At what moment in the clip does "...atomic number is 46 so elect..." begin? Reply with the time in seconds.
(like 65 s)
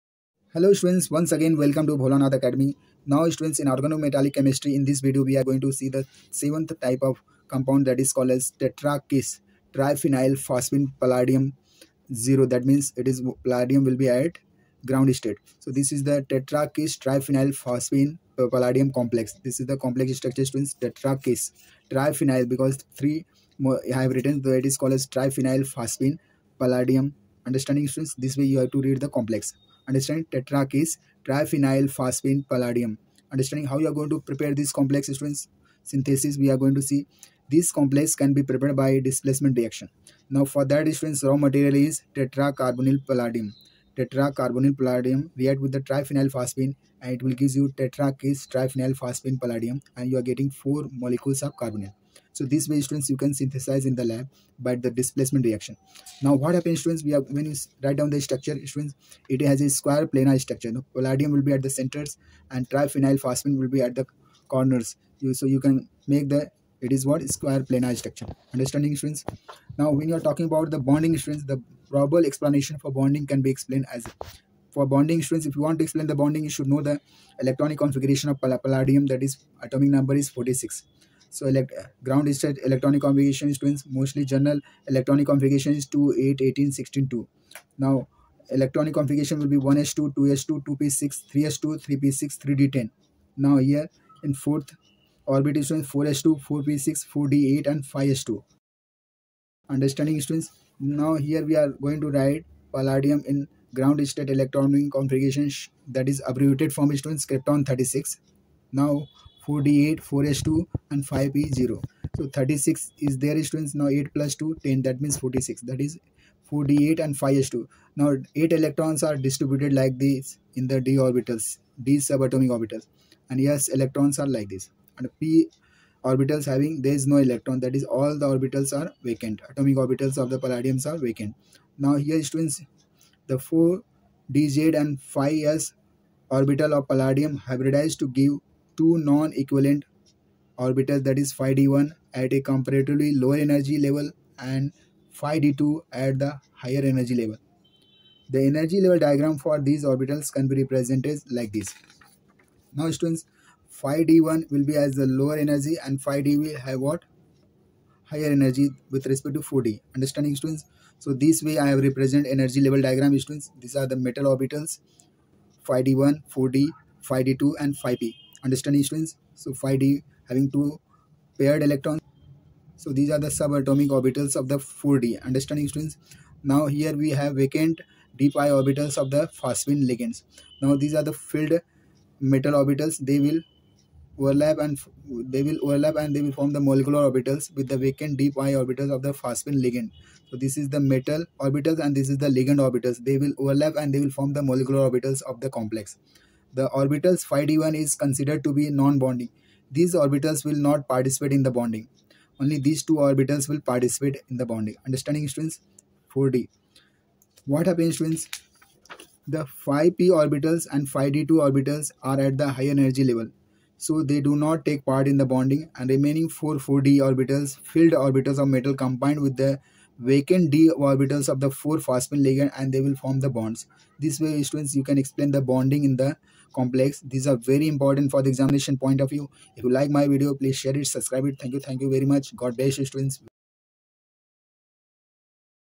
79 s.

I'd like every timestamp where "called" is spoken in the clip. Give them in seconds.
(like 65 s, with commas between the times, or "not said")
8 s, 24 s.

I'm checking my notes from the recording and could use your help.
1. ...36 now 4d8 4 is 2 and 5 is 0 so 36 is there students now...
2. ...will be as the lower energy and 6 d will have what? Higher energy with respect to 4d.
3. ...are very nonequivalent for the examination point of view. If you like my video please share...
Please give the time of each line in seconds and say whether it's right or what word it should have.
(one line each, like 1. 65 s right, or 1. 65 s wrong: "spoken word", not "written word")
1. 107 s right
2. 154 s wrong: "5", not "6"
3. 227 s wrong: "important", not "nonequivalent".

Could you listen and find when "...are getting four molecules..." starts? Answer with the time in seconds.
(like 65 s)
50 s.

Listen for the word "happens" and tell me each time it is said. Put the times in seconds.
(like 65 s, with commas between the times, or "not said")
56 s, 207 s.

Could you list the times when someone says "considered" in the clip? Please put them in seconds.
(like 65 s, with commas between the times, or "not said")
197 s.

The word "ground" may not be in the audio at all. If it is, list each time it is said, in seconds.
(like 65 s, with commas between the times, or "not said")
14 s, 82 s, 103 s.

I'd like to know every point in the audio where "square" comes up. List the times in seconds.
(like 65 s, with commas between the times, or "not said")
59 s, 67 s.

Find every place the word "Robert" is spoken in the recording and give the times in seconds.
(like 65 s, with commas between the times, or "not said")
not said.